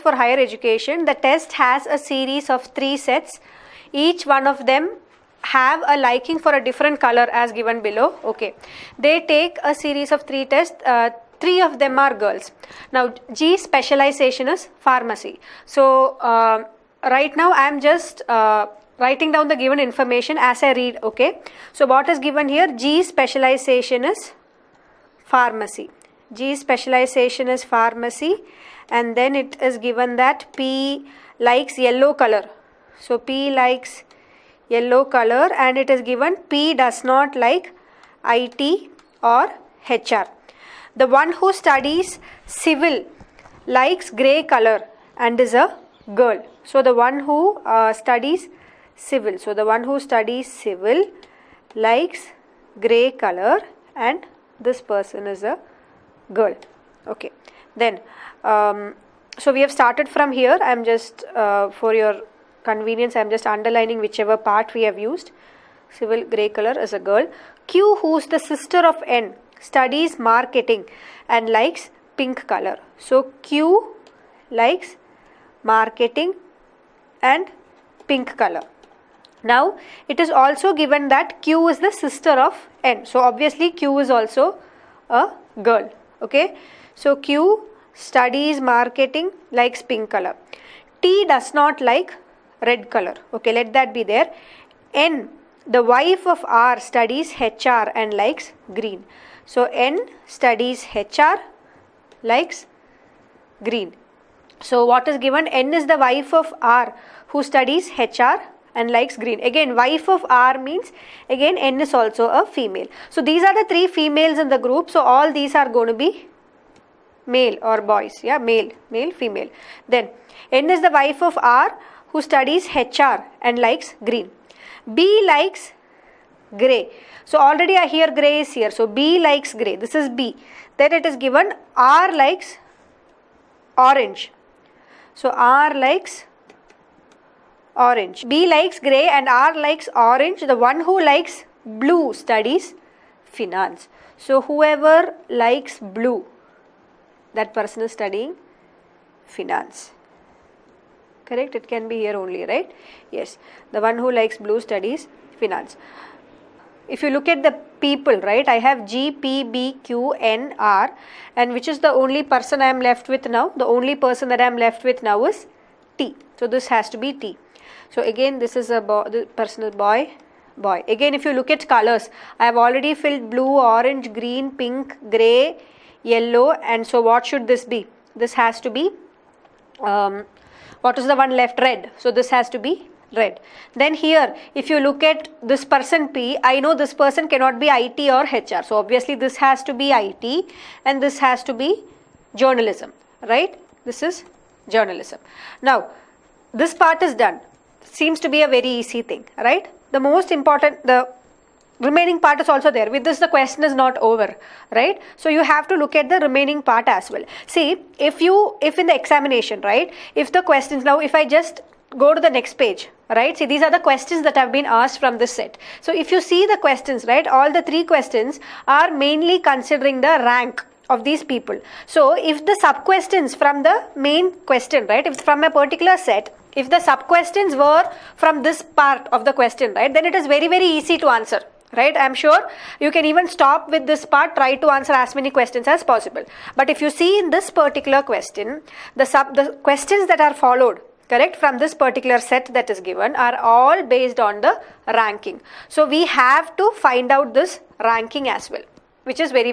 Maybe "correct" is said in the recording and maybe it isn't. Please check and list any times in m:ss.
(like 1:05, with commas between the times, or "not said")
2:31, 4:01.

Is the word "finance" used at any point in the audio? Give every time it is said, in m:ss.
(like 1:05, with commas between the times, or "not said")
2:23, 2:29, 2:35.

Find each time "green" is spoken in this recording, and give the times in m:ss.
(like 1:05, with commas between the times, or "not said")
1:38, 1:43, 1:49, 2:04, 2:54.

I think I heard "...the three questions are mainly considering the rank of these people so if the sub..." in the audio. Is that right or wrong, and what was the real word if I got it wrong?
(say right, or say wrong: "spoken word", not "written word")
right.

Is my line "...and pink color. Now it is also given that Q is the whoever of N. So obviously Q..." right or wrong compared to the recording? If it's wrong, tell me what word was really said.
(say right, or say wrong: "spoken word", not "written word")
wrong: "sister", not "whoever".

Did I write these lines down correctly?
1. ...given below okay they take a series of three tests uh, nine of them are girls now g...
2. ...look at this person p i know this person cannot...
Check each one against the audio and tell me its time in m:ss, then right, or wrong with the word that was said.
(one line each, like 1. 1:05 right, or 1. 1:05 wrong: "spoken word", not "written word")
1. 0:07 wrong: "three", not "nine"
2. 3:04 right.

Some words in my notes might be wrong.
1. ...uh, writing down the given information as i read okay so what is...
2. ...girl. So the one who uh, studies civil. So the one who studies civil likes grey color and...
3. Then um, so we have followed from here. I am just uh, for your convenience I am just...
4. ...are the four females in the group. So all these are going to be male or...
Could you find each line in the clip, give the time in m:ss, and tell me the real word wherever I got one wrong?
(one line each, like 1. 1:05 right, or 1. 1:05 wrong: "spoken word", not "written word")
1. 0:18 right
2. 0:46 right
3. 0:57 wrong: "started", not "followed"
4. 1:53 wrong: "three", not "four".